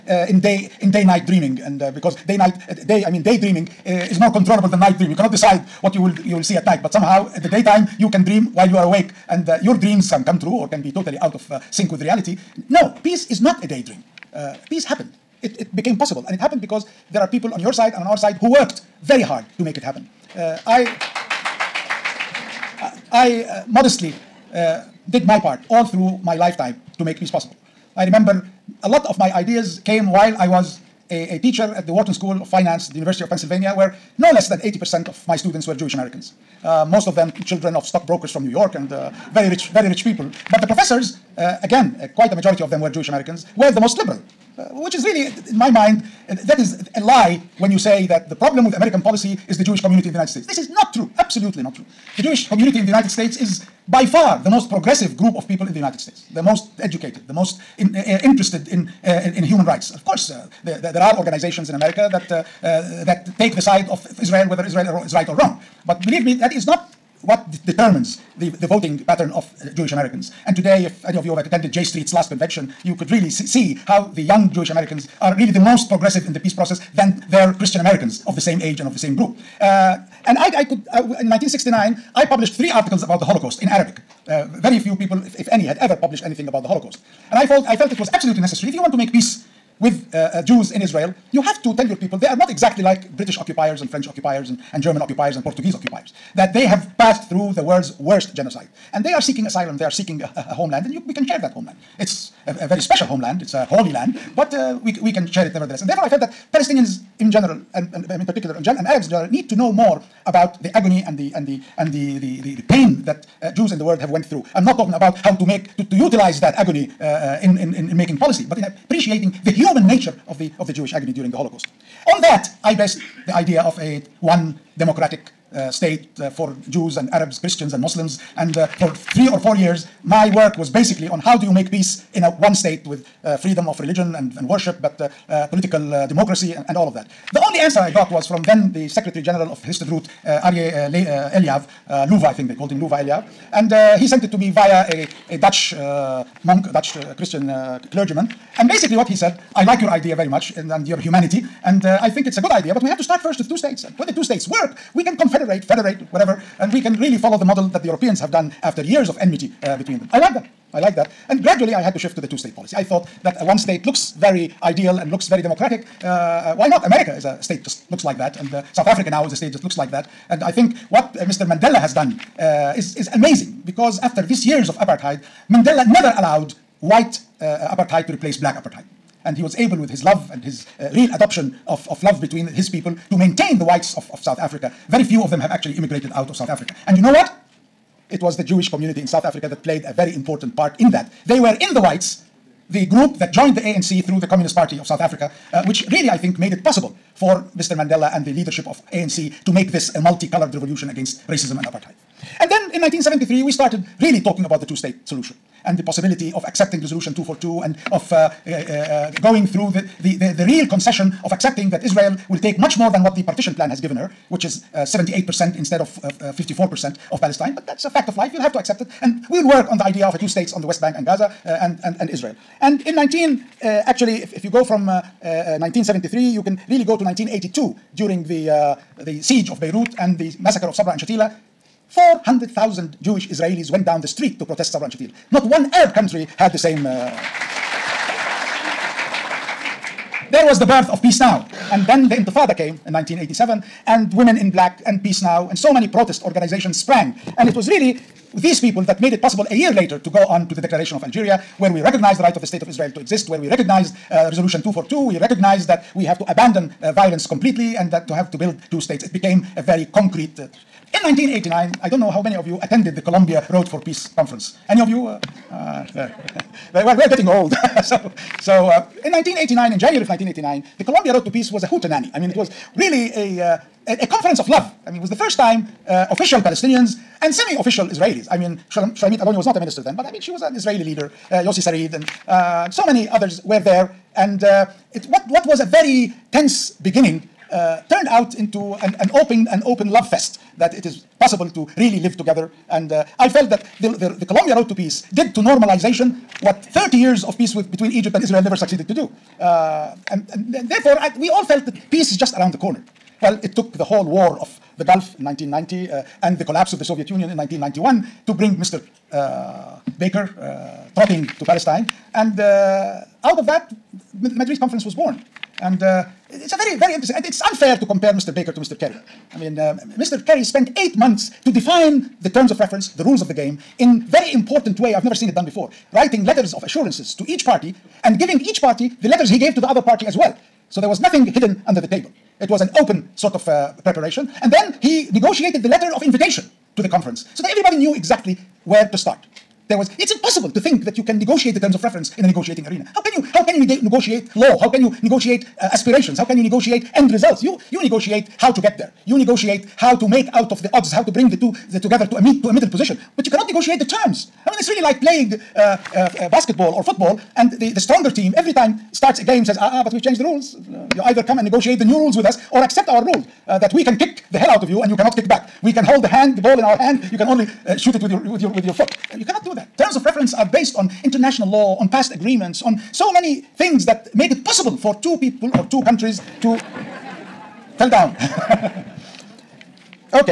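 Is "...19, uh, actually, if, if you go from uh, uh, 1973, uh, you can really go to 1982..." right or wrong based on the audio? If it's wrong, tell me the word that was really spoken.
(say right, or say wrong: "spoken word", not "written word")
right.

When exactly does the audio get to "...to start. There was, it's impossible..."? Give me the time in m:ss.
5:38.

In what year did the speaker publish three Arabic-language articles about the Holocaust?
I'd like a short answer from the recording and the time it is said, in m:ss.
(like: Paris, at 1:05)
1969, at 1:21.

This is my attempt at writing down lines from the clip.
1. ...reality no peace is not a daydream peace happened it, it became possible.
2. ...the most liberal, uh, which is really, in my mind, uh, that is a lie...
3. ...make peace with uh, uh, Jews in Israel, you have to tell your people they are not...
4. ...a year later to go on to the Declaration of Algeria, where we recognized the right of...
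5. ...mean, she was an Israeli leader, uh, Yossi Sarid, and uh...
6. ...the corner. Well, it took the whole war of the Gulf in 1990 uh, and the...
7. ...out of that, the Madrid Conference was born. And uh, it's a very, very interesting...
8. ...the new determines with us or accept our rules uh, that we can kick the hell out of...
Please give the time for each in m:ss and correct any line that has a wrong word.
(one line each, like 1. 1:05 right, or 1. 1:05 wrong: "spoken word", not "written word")
1. 0:12 right
2. 0:43 right
3. 1:28 right
4. 4:09 right
5. 4:40 right
6. 5:02 right
7. 5:13 right
8. 6:01 wrong: "rules", not "determines".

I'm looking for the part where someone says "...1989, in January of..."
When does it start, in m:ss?
4:29.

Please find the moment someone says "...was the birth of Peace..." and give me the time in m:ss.
4:00.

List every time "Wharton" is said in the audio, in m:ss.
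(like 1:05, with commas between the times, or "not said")
0:31.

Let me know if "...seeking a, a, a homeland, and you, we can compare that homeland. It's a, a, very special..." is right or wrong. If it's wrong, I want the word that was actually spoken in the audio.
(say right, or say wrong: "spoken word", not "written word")
wrong: "share", not "compare".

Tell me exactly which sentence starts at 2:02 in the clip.
On that, I based the idea of a one democratic uh, state uh, for Jews and Arabs, Christians and Muslims.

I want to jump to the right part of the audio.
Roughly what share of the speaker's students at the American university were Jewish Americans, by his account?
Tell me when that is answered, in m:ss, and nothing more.
0:34.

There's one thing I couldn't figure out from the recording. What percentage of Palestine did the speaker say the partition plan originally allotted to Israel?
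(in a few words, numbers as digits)
54%.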